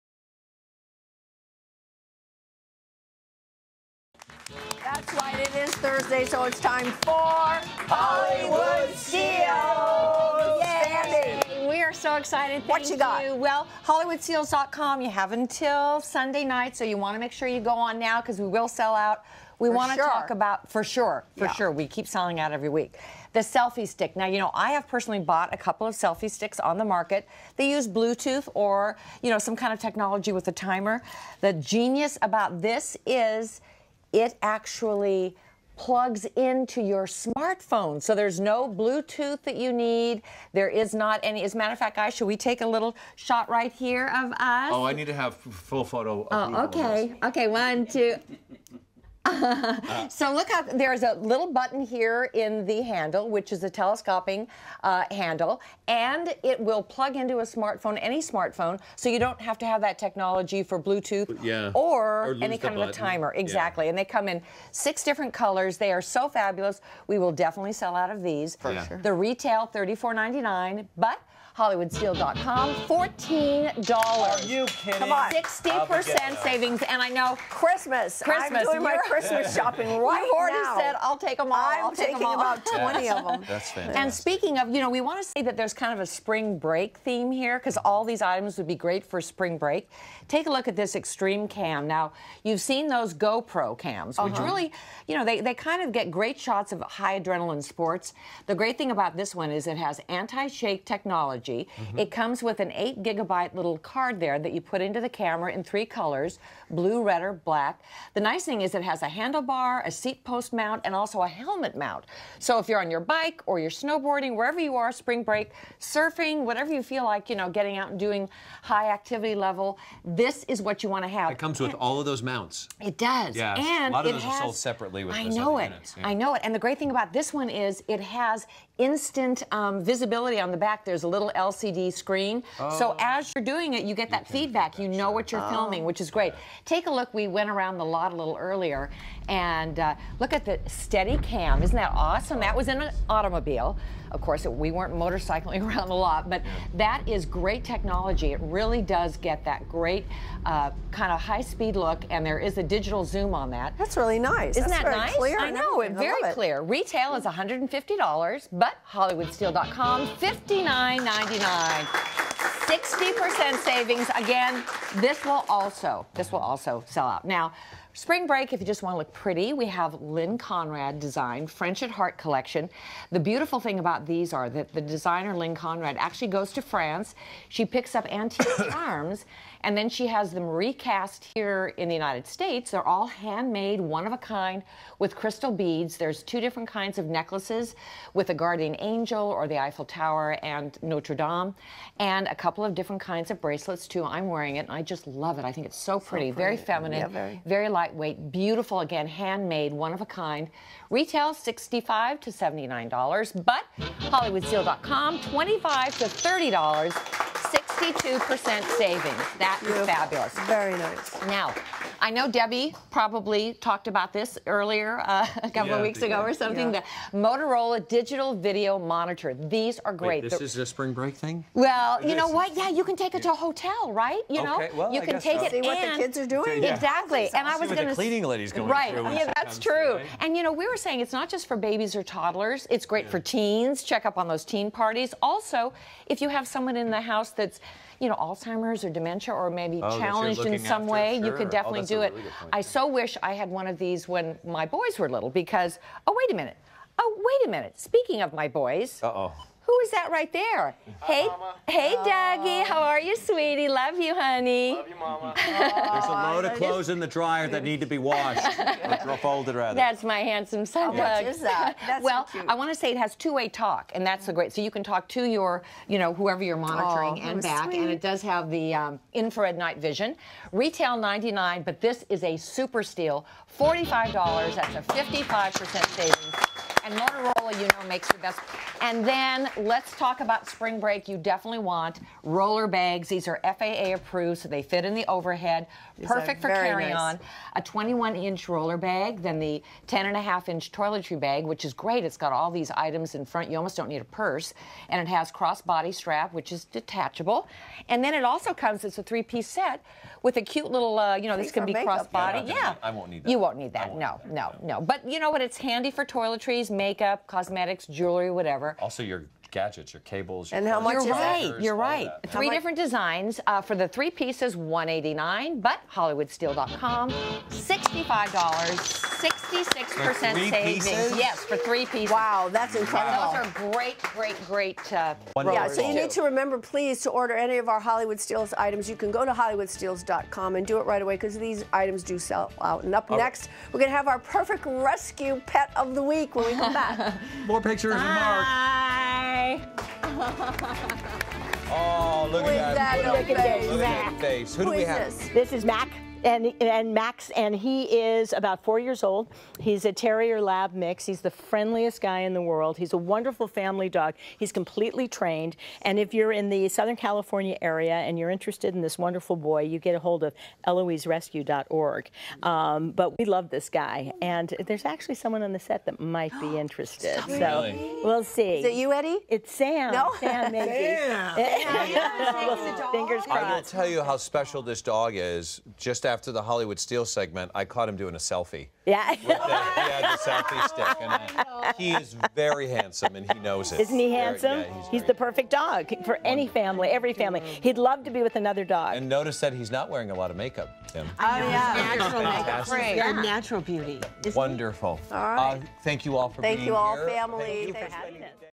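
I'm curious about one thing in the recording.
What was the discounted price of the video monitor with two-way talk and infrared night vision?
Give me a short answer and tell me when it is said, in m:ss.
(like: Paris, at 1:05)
$45, at 4:33.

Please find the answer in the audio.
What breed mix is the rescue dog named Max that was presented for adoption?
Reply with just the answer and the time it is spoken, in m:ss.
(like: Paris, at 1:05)
Terrier Lab mix, at 5:49.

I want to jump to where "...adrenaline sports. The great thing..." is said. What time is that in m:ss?
1:37.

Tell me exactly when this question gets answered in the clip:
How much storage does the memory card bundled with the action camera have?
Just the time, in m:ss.
1:42.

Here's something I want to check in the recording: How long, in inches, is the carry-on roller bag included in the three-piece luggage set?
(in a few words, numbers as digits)
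21 inches.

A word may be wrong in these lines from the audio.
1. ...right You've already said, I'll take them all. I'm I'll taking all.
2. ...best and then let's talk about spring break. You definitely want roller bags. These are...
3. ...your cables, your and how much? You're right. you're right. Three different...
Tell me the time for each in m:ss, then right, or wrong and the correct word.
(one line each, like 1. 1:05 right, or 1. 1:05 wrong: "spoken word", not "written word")
1. 1:19 right
2. 4:38 right
3. 5:09 right.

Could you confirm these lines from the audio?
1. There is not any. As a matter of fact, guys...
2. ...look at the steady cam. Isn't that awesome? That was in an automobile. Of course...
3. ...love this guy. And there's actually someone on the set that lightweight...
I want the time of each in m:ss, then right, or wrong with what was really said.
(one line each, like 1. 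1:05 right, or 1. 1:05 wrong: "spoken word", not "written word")
1. 0:40 right
2. 2:20 right
3. 6:03 wrong: "might", not "lightweight".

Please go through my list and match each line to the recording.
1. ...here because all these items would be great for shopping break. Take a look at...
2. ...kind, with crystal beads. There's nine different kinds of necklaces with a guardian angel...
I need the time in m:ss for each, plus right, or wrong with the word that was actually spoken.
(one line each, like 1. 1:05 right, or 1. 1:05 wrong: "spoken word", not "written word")
1. 1:27 wrong: "spring", not "shopping"
2. 3:04 wrong: "two", not "nine".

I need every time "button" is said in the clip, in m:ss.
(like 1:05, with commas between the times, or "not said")
0:51, 1:02.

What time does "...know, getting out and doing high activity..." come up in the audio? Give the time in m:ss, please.
1:57.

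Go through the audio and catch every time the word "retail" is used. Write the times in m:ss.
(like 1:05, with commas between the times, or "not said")
1:09, 2:36, 3:20, 4:30.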